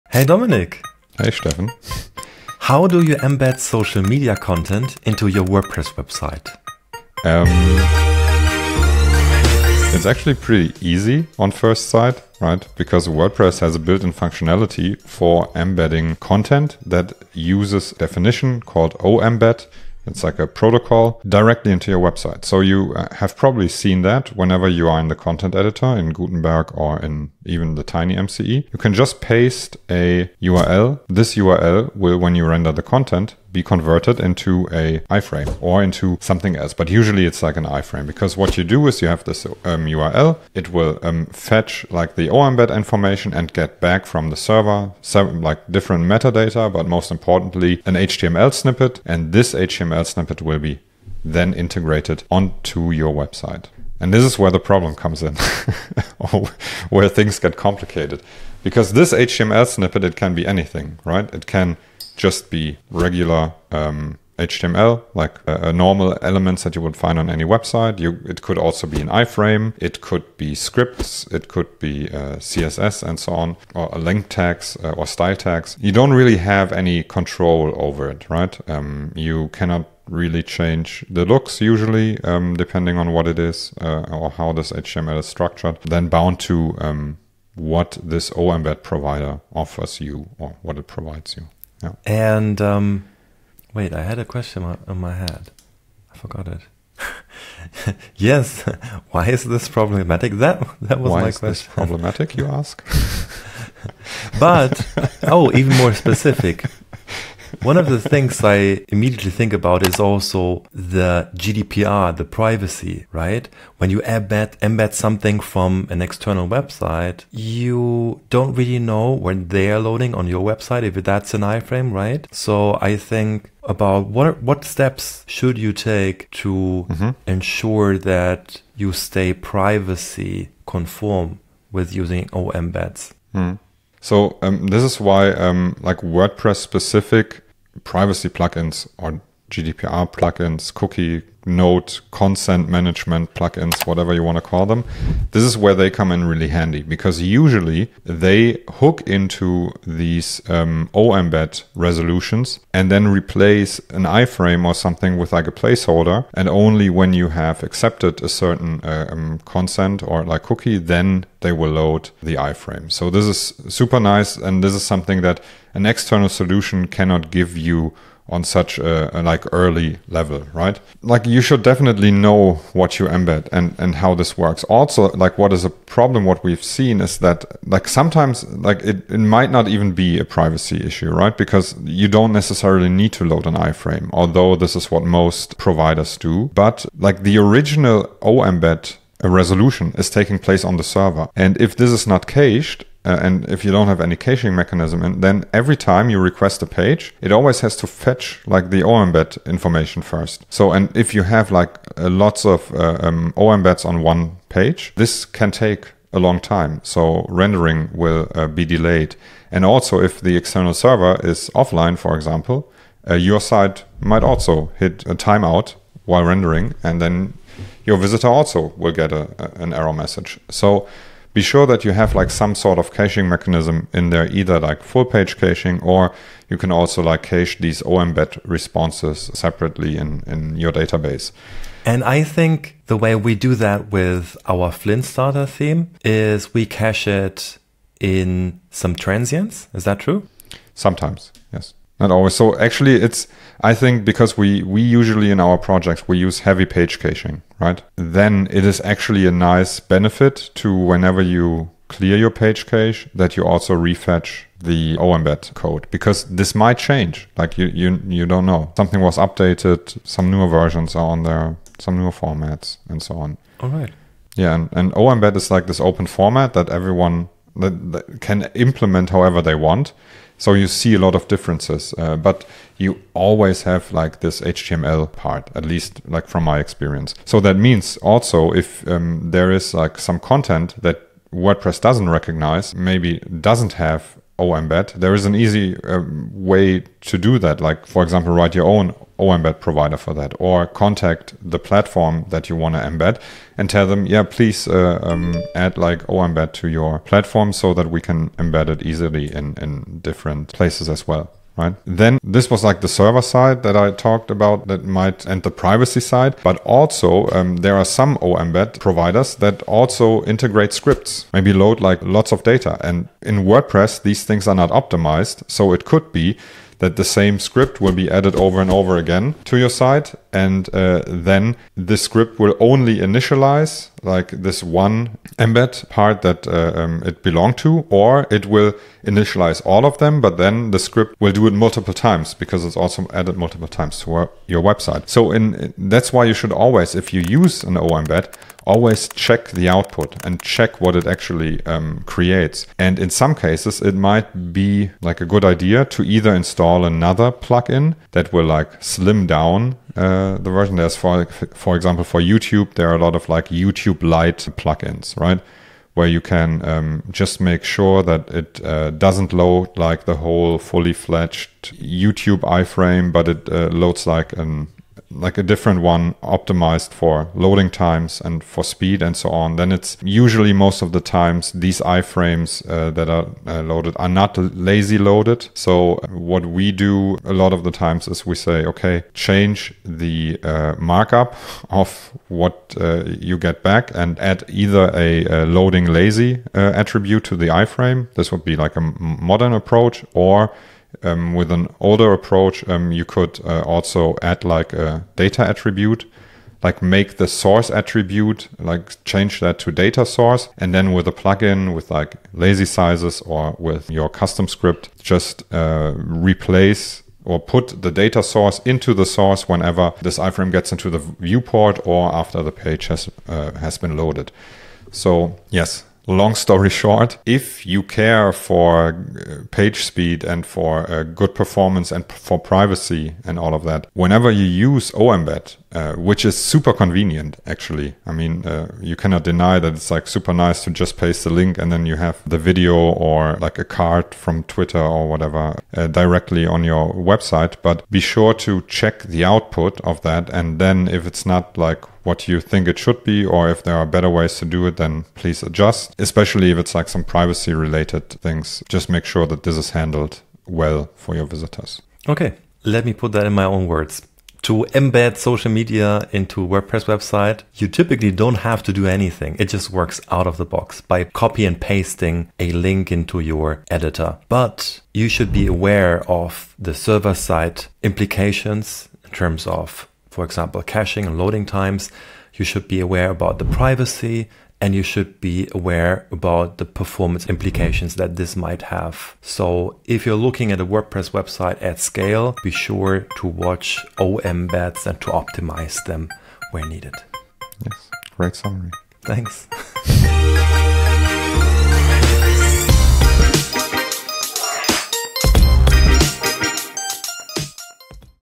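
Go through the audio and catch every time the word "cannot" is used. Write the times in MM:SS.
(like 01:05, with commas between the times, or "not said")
01:19, 02:46, 07:08.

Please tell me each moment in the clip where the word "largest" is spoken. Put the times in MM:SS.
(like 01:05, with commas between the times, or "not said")
not said.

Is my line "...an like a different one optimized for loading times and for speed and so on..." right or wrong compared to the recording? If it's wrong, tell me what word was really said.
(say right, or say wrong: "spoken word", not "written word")
right.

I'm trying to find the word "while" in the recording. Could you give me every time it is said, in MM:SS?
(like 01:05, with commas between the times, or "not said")
03:36.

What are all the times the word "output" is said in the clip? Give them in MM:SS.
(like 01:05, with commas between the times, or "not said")
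05:39, 07:19.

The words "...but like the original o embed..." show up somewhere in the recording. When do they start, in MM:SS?
03:06.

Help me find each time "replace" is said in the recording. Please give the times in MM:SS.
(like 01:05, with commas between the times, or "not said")
02:33, 06:45.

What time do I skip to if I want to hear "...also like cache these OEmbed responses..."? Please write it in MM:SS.
03:46.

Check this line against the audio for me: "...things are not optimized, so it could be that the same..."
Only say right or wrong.
right.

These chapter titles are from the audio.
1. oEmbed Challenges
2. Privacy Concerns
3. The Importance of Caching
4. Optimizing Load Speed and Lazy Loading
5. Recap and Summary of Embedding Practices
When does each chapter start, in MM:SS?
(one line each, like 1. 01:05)
1. 00:54
2. 01:44
3. 02:55
4. 05:02
5. 07:32.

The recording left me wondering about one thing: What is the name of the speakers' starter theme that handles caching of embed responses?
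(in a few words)
Flynt.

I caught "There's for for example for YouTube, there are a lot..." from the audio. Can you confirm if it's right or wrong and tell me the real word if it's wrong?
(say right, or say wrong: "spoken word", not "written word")
right.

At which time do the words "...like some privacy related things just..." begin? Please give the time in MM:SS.
07:26.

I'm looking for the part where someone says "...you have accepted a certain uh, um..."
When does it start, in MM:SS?
02:37.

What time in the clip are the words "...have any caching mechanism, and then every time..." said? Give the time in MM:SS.
03:13.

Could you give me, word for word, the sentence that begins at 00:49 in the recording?
And this HTML snippet will be then integrated onto your website.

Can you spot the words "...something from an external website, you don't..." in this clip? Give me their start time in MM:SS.
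01:54.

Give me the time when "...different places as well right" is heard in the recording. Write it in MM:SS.
05:00.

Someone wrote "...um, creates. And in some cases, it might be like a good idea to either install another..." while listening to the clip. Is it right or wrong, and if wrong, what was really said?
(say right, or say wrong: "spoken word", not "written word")
right.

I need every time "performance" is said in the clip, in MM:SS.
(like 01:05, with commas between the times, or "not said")
07:01, 07:56.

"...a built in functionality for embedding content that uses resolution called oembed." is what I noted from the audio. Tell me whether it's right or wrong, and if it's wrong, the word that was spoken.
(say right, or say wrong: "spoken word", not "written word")
wrong: "definition", not "resolution".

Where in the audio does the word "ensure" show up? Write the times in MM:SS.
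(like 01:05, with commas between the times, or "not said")
02:07.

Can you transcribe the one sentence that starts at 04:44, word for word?
Oh, there is an easy um, way to do that.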